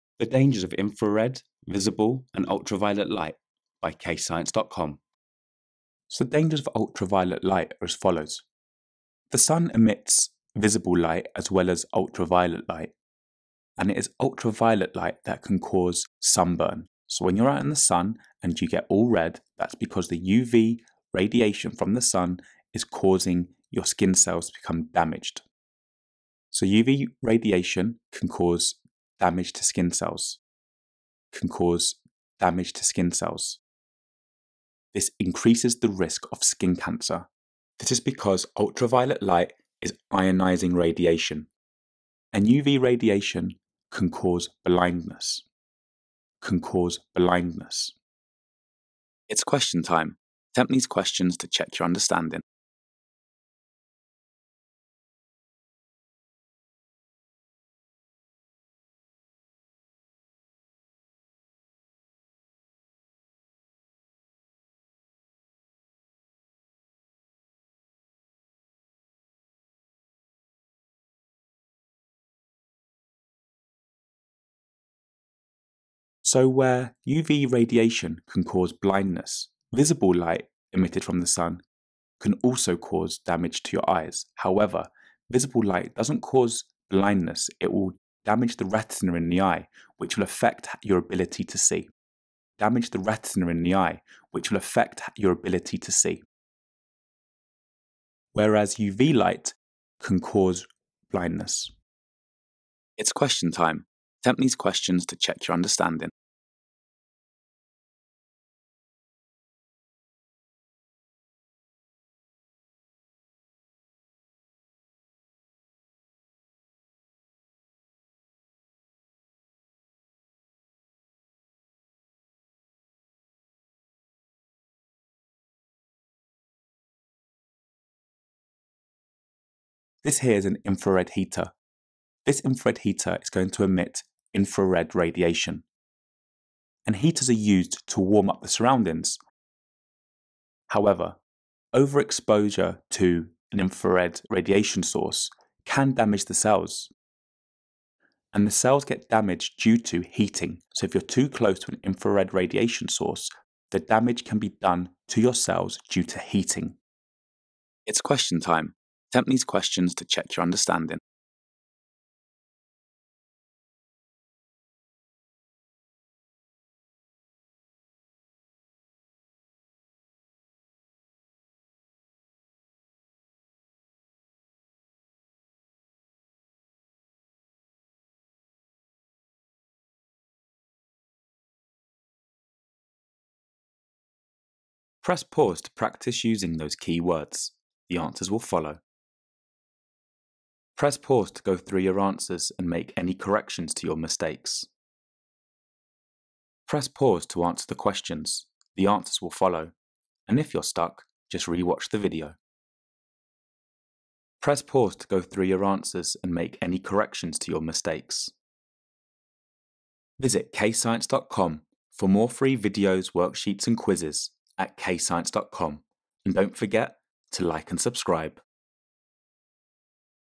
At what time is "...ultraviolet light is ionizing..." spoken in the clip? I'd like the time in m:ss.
0:38.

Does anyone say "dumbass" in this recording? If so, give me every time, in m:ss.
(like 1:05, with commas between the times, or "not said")
not said.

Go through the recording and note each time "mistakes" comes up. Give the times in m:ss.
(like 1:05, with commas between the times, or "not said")
3:13, 3:27.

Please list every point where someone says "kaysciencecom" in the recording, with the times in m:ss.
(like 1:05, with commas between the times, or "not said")
0:03, 3:30, 3:34.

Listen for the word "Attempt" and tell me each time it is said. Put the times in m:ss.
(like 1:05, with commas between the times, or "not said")
0:50, 1:44, 2:39.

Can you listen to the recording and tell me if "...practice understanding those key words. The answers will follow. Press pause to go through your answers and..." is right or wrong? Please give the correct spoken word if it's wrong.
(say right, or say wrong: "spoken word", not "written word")
wrong: "using", not "understanding".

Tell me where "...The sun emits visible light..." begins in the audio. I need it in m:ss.
0:09.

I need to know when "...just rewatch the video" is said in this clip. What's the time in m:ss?
3:21.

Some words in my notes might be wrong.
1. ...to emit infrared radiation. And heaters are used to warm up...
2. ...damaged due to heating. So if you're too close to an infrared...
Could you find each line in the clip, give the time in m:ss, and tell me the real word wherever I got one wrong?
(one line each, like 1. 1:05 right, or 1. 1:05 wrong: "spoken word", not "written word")
1. 2:13 right
2. 2:29 right.